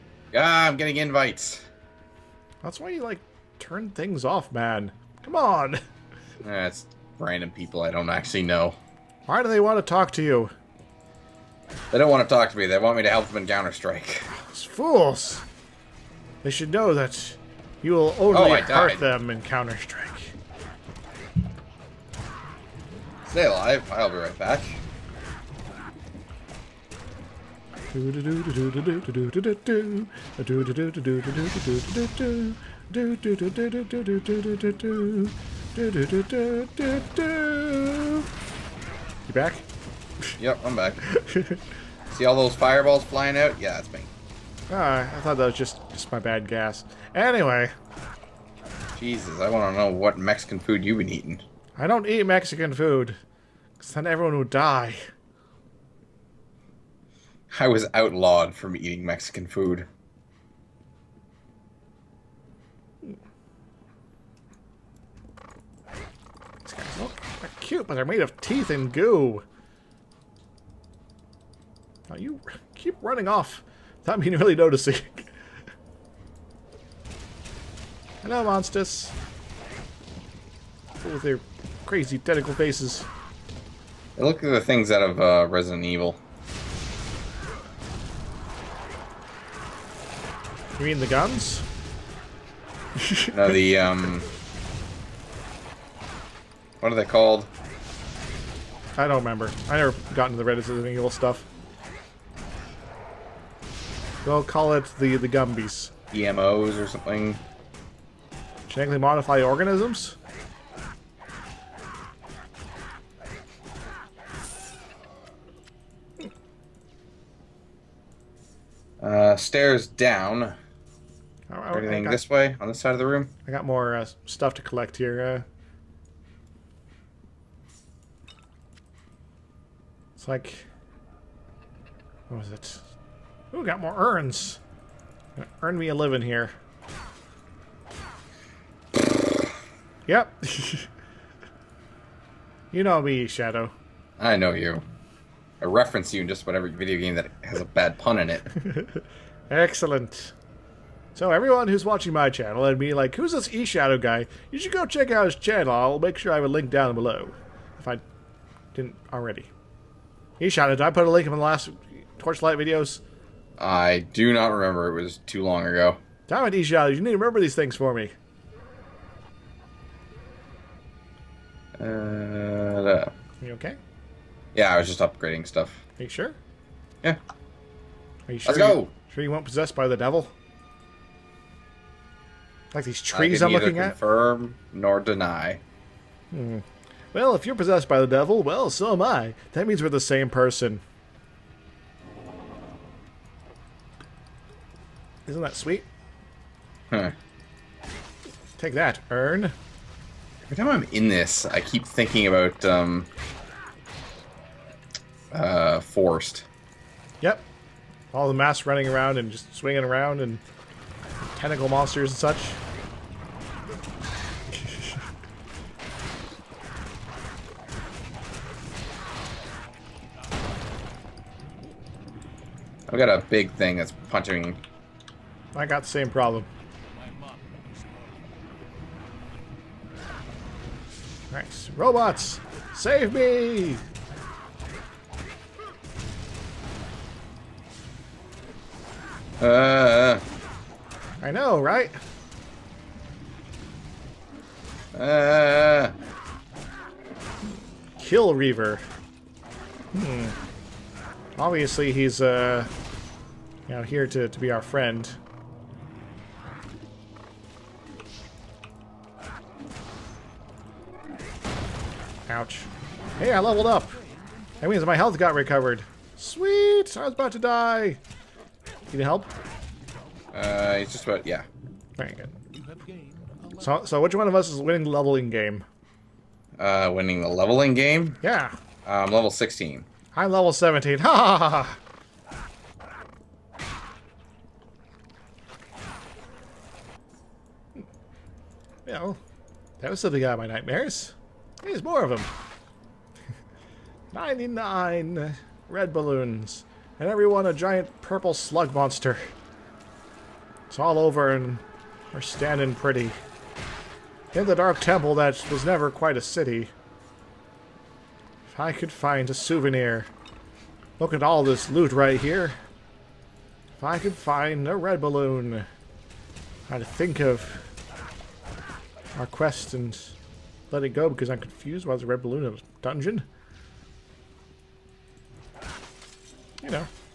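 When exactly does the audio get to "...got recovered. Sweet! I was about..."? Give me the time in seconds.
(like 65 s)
265 s.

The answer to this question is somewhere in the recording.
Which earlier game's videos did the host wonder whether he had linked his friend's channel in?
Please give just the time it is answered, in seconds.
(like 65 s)
162 s.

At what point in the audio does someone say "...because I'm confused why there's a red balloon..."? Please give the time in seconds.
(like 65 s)
321 s.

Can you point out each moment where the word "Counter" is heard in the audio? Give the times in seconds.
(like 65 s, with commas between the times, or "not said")
13 s, 19 s.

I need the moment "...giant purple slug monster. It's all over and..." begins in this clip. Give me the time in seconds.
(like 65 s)
297 s.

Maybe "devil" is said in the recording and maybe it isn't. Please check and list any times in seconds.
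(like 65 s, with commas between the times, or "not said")
179 s, 188 s.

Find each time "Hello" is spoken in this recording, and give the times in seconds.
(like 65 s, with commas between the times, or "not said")
78 s.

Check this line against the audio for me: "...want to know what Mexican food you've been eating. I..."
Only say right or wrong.
right.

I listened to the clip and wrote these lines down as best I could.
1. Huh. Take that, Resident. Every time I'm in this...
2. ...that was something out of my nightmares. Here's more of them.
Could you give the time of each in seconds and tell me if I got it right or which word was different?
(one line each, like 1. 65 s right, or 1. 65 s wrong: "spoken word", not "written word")
1. 196 s wrong: "Earn", not "Resident"
2. 289 s right.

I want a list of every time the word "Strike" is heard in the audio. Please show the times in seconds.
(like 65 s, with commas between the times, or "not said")
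13 s, 19 s.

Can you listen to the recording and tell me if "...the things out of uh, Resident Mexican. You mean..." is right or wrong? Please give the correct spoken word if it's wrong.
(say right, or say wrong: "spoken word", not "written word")
wrong: "Evil", not "Mexican".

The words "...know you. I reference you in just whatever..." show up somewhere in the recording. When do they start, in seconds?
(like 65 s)
144 s.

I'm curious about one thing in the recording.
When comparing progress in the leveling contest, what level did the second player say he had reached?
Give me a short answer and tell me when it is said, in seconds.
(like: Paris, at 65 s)
17, at 280 s.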